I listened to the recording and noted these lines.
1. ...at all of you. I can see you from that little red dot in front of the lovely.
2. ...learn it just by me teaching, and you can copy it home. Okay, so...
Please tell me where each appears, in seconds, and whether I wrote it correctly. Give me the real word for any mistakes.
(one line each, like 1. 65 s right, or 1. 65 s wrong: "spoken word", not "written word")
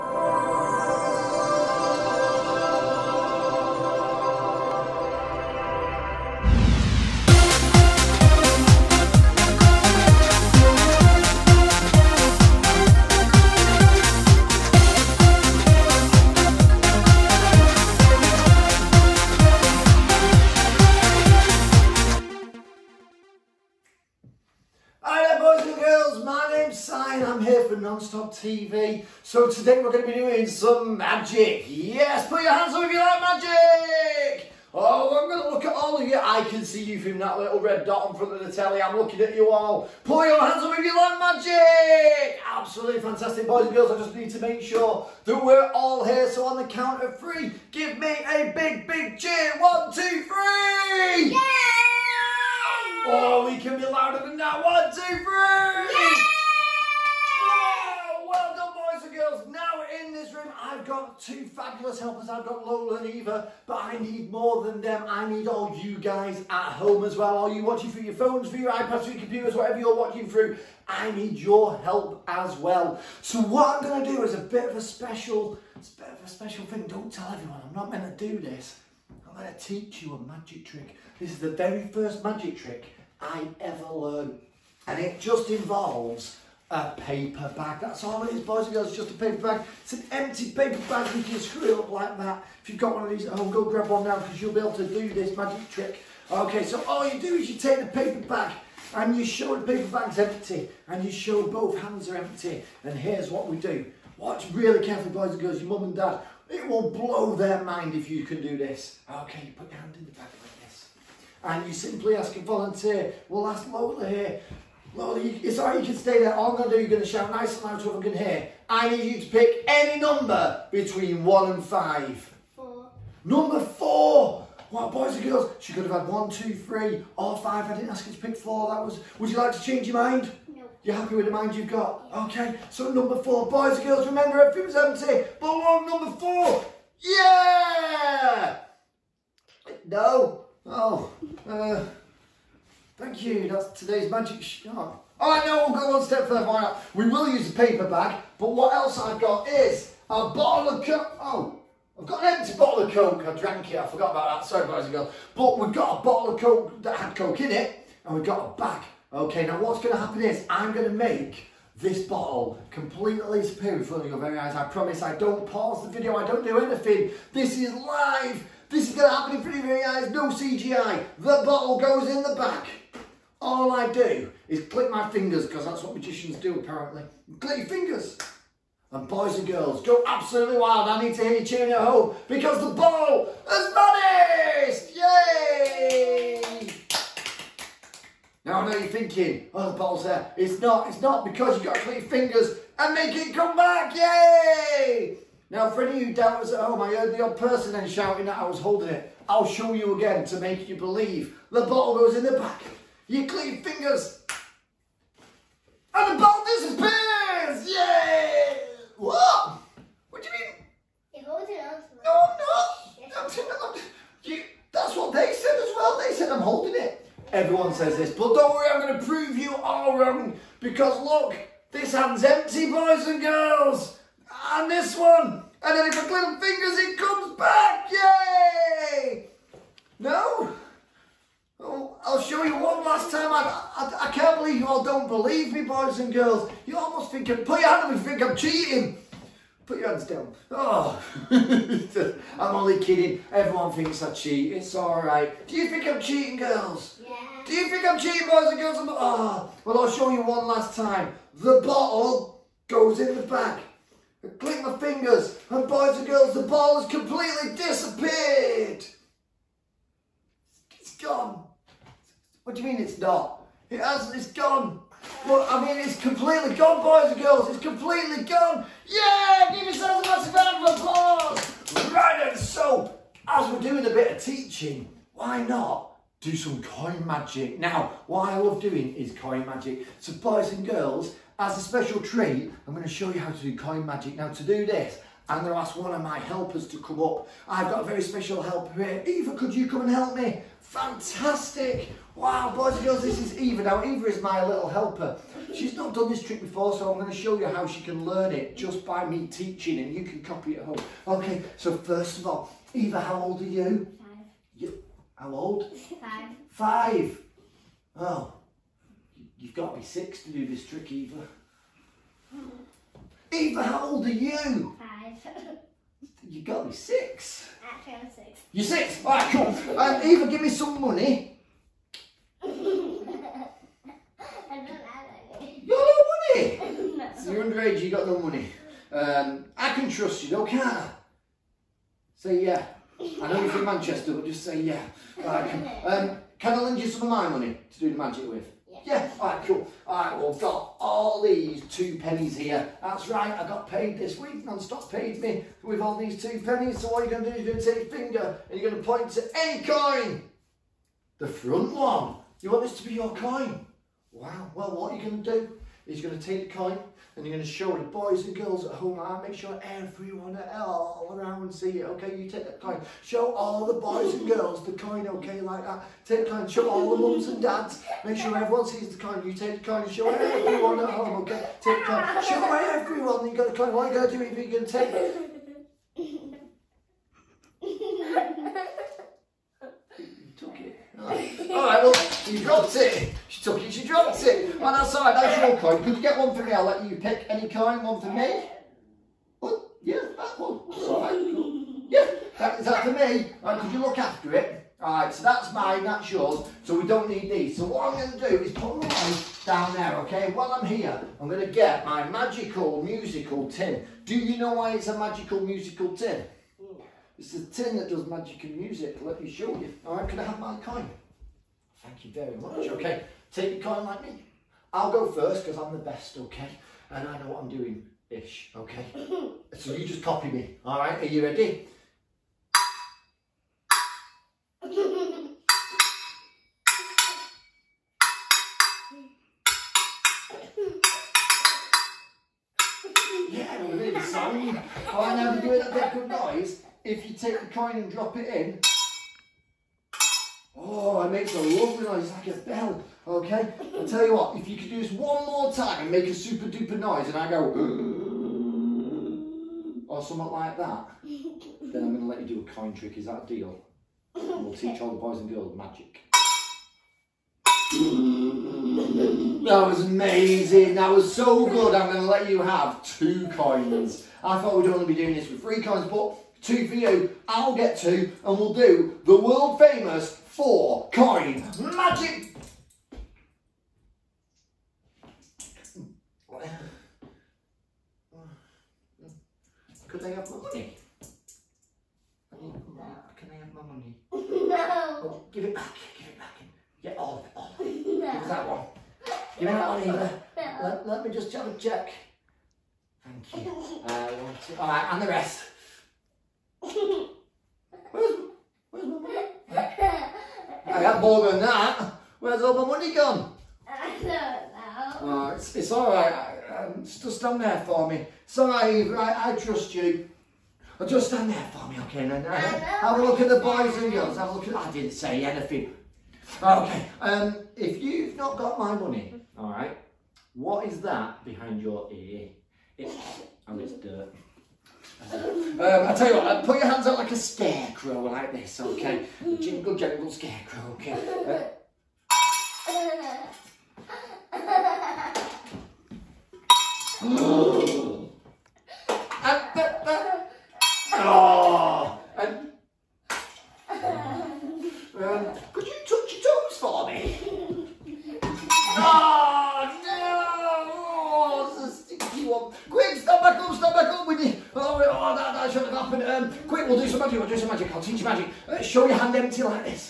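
1. 35 s wrong: "telly", not "lovely"
2. 298 s right.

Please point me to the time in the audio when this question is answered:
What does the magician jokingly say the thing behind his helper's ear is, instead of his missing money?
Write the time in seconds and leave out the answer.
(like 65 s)
523 s.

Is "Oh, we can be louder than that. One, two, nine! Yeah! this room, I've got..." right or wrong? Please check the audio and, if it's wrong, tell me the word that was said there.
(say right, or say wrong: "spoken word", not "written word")
wrong: "three", not "nine".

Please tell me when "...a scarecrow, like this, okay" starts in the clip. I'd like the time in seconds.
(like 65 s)
527 s.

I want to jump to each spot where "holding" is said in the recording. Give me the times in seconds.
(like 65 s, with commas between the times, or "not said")
198 s, 211 s, 216 s.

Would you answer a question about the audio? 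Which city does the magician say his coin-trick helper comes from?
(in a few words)
Manchester.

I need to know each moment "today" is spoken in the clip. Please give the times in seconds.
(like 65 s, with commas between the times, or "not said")
29 s, 143 s.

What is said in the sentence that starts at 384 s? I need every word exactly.
And I said, that's your coin.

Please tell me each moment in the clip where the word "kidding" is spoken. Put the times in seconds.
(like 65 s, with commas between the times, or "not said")
242 s.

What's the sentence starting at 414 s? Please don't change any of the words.
I'll go first because I'm the best, okay?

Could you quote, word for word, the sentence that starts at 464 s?
I thought we'd only be doing this with three coins, but two for you.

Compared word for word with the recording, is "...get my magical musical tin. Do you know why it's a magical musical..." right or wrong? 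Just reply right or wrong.
right.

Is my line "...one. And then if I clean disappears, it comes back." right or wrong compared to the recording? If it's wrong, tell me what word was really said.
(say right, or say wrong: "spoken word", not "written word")
wrong: "fingers", not "disappears".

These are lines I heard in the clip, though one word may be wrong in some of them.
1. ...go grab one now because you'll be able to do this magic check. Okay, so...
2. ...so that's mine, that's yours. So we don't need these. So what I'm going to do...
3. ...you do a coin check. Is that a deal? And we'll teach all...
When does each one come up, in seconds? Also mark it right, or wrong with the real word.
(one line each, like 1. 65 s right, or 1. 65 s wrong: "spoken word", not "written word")
1. 93 s wrong: "trick", not "check"
2. 395 s right
3. 452 s wrong: "trick", not "check".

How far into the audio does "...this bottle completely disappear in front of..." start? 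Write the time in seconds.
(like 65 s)
161 s.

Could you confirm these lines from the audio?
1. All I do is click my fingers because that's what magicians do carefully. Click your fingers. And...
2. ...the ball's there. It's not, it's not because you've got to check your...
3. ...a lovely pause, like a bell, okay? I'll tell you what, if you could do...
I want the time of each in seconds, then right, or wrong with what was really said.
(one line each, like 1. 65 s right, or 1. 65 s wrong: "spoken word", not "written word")
1. 173 s wrong: "apparently", not "carefully"
2. 189 s wrong: "click", not "check"
3. 441 s wrong: "noise", not "pause".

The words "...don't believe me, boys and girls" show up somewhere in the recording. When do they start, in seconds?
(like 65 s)
234 s.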